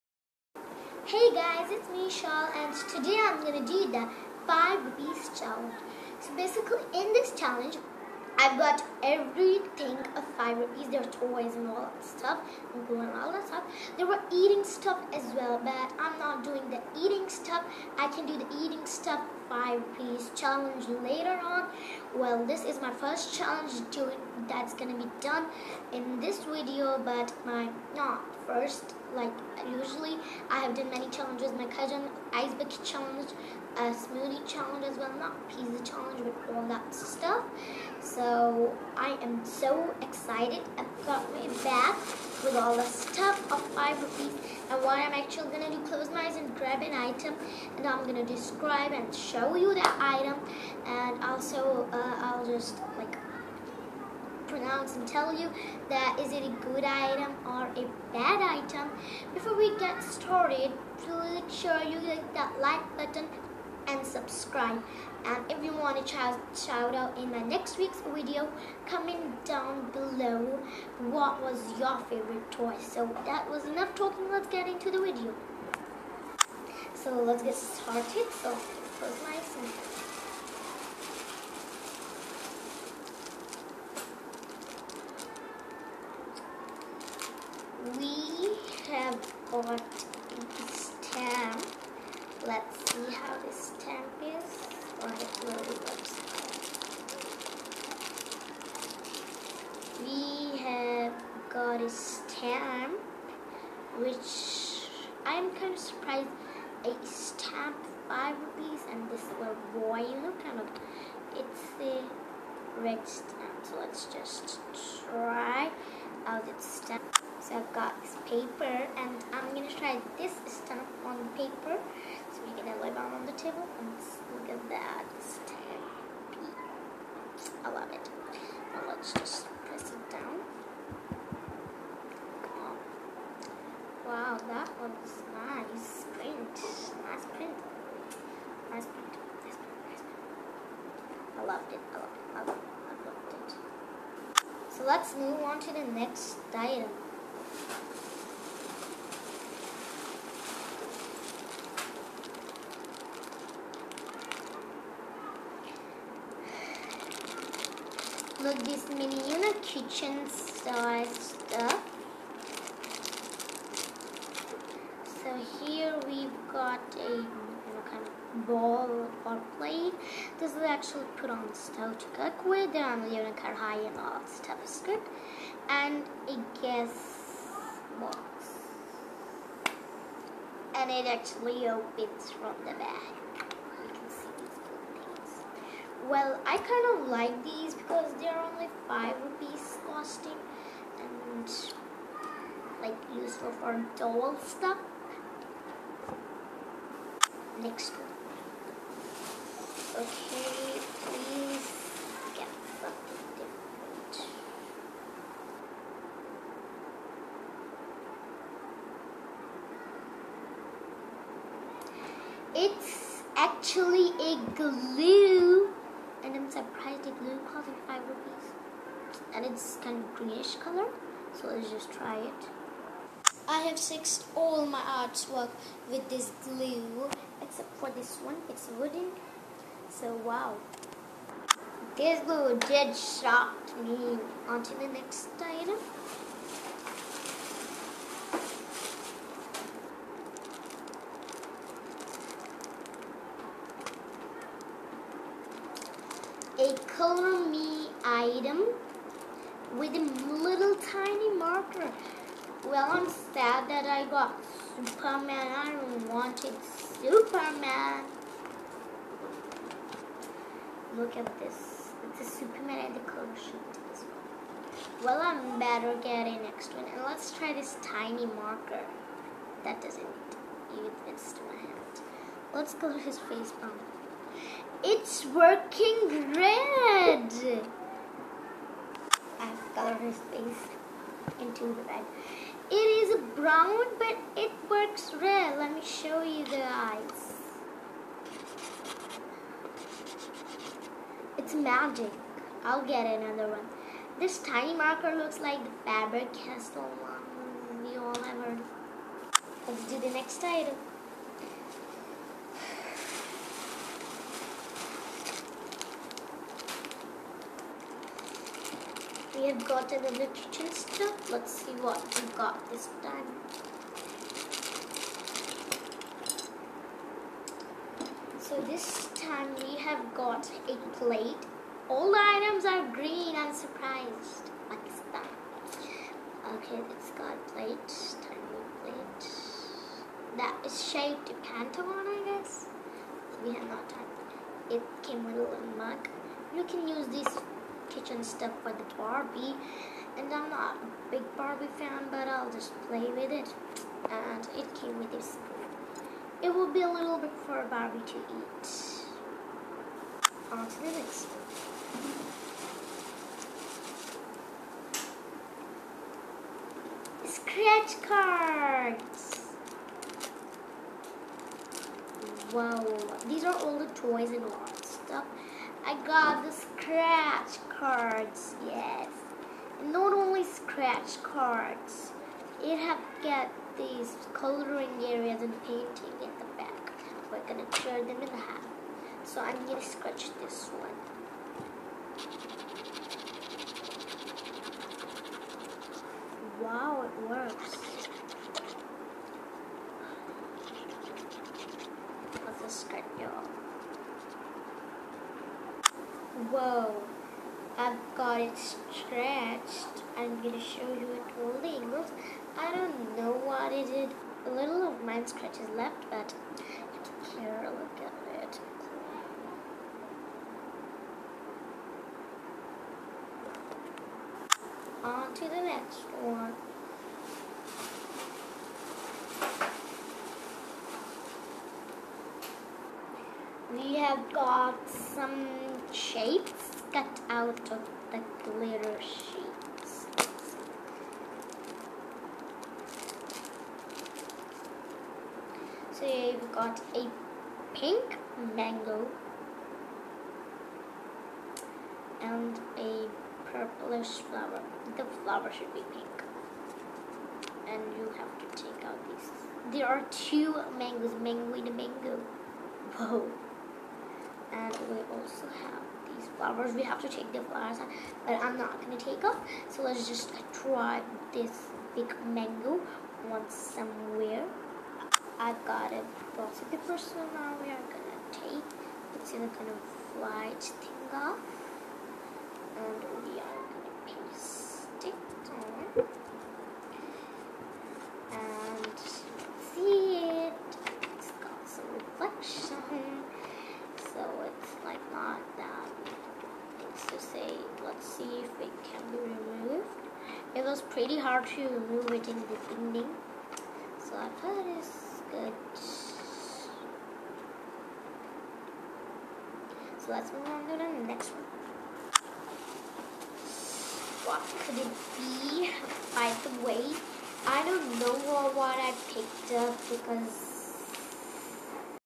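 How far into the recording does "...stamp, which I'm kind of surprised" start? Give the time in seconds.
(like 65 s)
101 s.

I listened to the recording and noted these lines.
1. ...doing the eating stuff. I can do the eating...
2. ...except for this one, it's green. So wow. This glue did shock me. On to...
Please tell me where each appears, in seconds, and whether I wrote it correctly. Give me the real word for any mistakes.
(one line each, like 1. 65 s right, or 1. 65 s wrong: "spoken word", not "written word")
1. 16 s right
2. 227 s wrong: "wooden", not "green".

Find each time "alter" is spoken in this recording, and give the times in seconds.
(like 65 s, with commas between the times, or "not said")
not said.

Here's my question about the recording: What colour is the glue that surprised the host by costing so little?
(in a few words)
Greenish.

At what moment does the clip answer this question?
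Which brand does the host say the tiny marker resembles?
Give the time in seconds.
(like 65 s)
295 s.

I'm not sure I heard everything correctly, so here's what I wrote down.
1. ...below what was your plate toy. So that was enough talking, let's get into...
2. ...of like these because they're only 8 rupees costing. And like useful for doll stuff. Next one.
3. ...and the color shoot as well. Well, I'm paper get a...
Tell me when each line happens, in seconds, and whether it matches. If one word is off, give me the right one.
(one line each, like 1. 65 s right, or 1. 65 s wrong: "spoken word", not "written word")
1. 69 s wrong: "favorite", not "plate"
2. 187 s wrong: "5", not "8"
3. 262 s wrong: "better", not "paper".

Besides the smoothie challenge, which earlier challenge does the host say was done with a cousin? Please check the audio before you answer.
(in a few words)
ice bucket challenge.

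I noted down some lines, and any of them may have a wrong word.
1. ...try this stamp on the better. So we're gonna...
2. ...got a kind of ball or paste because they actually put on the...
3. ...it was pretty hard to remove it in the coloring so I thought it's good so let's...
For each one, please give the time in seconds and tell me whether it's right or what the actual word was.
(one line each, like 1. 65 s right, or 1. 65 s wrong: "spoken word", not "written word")
1. 119 s wrong: "paper", not "better"
2. 166 s wrong: "plate", not "paste"
3. 490 s wrong: "beginning", not "coloring".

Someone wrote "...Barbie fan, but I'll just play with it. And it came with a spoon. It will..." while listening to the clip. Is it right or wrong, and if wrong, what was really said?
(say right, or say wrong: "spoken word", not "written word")
right.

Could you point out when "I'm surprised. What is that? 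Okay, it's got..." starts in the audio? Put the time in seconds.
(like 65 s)
323 s.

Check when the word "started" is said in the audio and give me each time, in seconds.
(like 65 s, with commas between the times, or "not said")
60 s, 77 s.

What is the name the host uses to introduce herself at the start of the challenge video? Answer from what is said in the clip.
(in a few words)
Shal.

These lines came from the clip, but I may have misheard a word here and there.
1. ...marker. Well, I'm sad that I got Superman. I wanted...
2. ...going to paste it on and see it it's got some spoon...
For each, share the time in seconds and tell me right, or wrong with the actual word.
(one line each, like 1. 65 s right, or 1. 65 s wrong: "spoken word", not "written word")
1. 251 s right
2. 473 s wrong: "reflection", not "spoon".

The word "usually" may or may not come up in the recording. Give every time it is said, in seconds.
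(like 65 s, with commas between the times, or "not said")
29 s.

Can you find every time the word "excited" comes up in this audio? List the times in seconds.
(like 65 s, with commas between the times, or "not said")
40 s.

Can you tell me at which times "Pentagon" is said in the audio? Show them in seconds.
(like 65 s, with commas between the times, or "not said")
331 s.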